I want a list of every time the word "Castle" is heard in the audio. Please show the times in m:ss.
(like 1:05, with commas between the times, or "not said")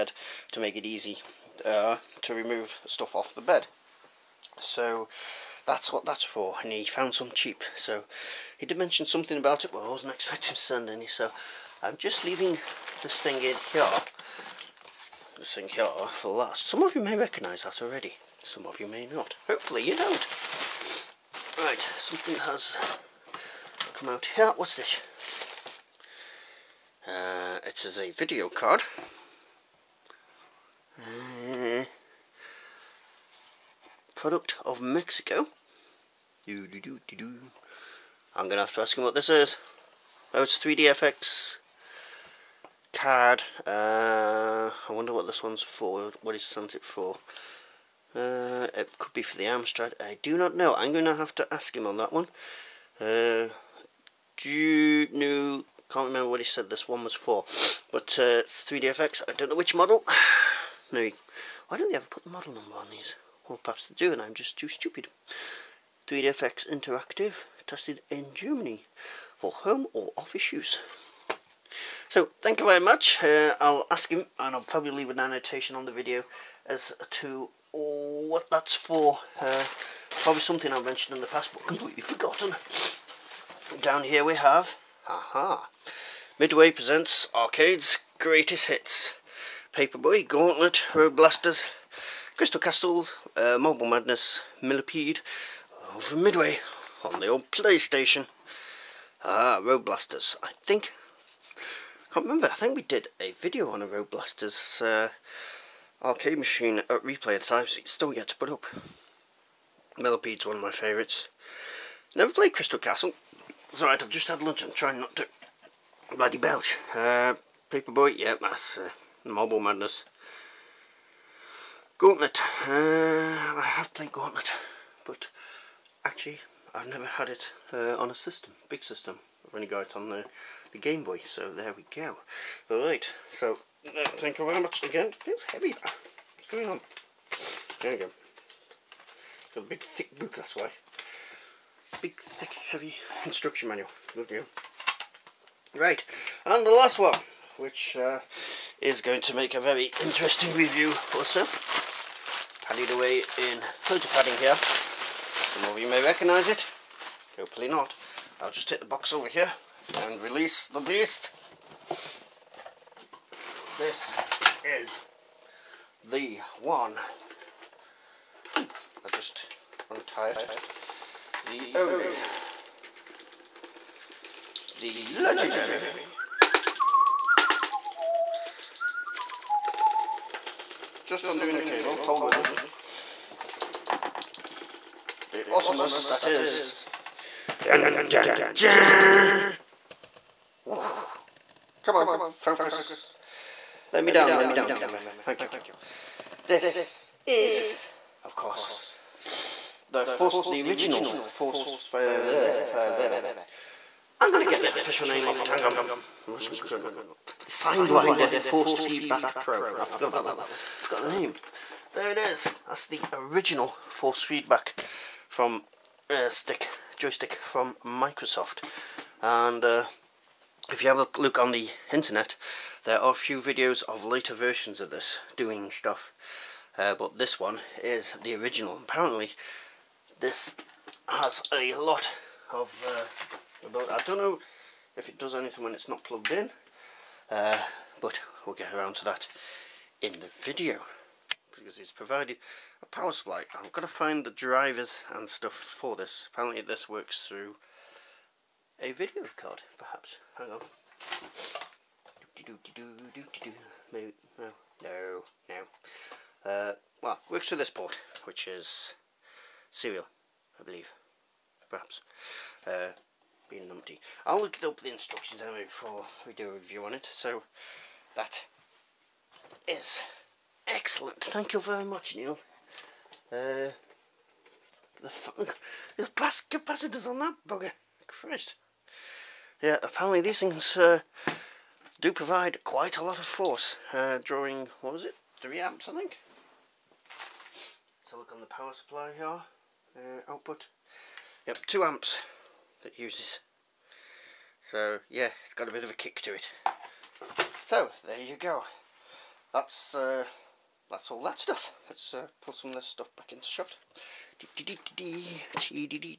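1:32, 1:52.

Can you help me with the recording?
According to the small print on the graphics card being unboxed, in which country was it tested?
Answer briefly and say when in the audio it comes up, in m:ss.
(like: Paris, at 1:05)
Germany, at 1:08.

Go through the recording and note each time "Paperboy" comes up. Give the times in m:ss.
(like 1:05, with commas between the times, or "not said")
1:29, 1:57.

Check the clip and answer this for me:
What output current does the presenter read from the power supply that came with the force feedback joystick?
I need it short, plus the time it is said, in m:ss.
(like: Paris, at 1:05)
2 amps, at 4:51.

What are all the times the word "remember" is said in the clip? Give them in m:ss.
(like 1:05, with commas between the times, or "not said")
0:56, 1:42.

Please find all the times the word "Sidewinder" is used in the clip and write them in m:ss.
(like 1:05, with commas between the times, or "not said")
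3:27.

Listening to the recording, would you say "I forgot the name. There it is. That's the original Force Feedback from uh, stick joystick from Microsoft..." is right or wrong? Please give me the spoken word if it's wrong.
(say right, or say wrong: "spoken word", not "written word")
right.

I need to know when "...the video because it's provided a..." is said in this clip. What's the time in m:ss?
4:00.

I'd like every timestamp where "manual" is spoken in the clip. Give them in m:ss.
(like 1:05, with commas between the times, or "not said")
2:23.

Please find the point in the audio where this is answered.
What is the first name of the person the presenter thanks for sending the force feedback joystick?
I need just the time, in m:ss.
4:32.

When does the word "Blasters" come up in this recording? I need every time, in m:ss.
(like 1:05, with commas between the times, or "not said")
1:31, 1:39, 1:44.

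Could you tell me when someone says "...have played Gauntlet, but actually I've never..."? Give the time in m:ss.
2:03.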